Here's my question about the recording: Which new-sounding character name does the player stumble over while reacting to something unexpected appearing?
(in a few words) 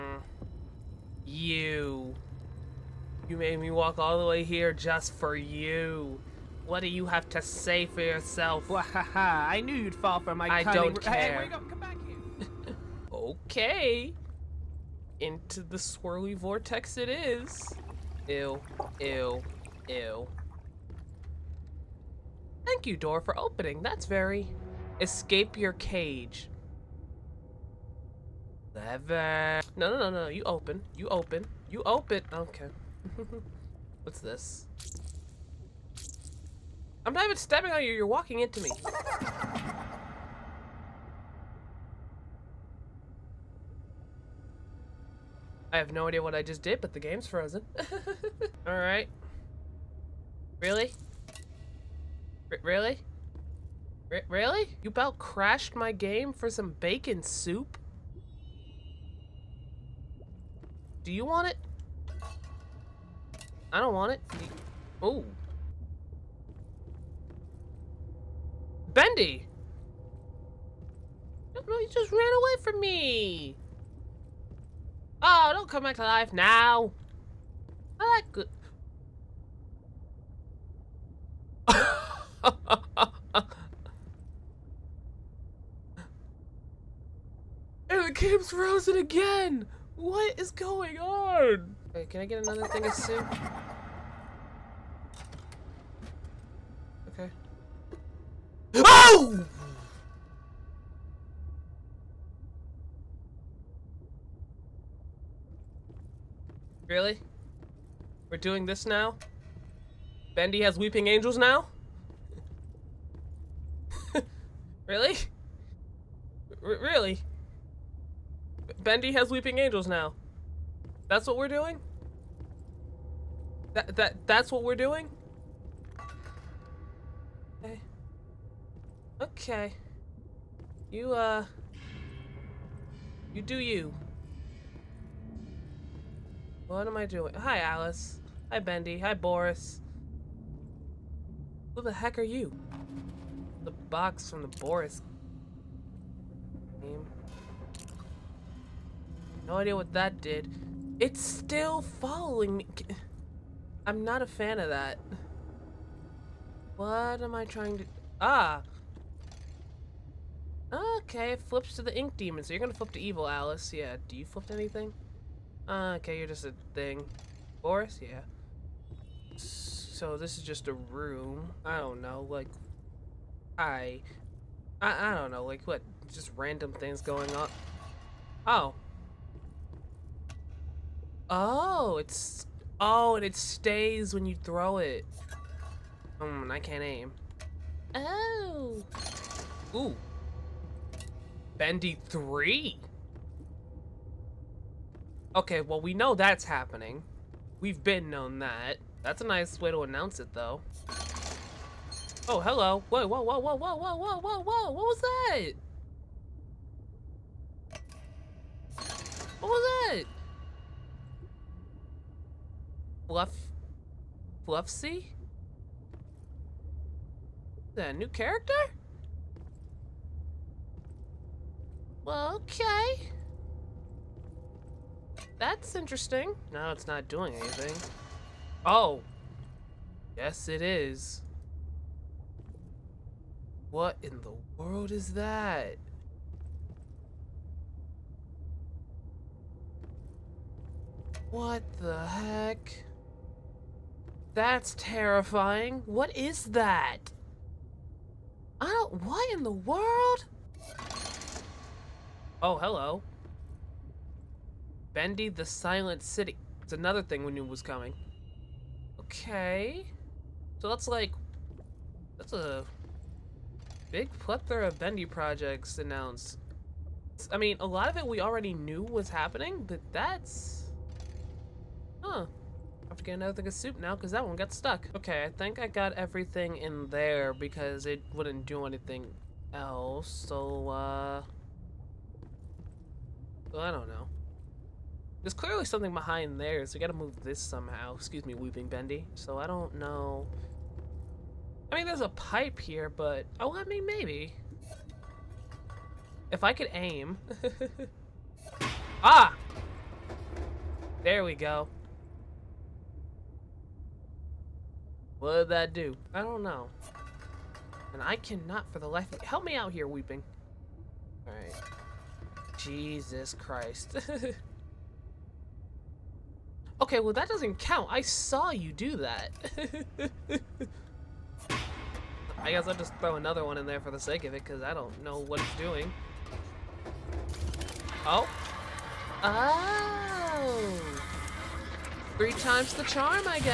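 Fluffsy.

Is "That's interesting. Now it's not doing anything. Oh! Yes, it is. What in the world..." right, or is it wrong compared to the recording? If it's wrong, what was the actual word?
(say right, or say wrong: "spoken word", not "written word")
right.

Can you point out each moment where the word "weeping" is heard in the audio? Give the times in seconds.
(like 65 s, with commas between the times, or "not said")
110 s, 119 s, 288 s, 309 s.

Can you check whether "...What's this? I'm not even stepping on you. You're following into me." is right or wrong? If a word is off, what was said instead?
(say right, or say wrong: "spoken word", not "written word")
wrong: "walking", not "following".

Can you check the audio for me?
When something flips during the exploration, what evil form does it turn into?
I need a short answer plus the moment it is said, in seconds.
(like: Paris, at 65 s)
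The Ink Demon, at 161 s.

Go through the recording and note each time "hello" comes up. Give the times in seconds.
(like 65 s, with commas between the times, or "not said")
202 s, 252 s.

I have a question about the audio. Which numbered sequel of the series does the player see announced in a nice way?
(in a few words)
Bendy 3.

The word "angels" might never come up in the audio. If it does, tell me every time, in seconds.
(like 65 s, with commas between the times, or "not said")
111 s, 119 s.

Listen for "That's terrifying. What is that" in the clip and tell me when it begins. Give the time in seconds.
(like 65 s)
244 s.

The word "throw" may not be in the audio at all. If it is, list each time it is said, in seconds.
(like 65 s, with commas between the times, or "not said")
184 s, 322 s.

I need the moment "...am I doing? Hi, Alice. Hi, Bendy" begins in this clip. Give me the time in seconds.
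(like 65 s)
136 s.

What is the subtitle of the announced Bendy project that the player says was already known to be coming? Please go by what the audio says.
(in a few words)
The Silent City.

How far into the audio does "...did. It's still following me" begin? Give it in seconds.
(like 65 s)
150 s.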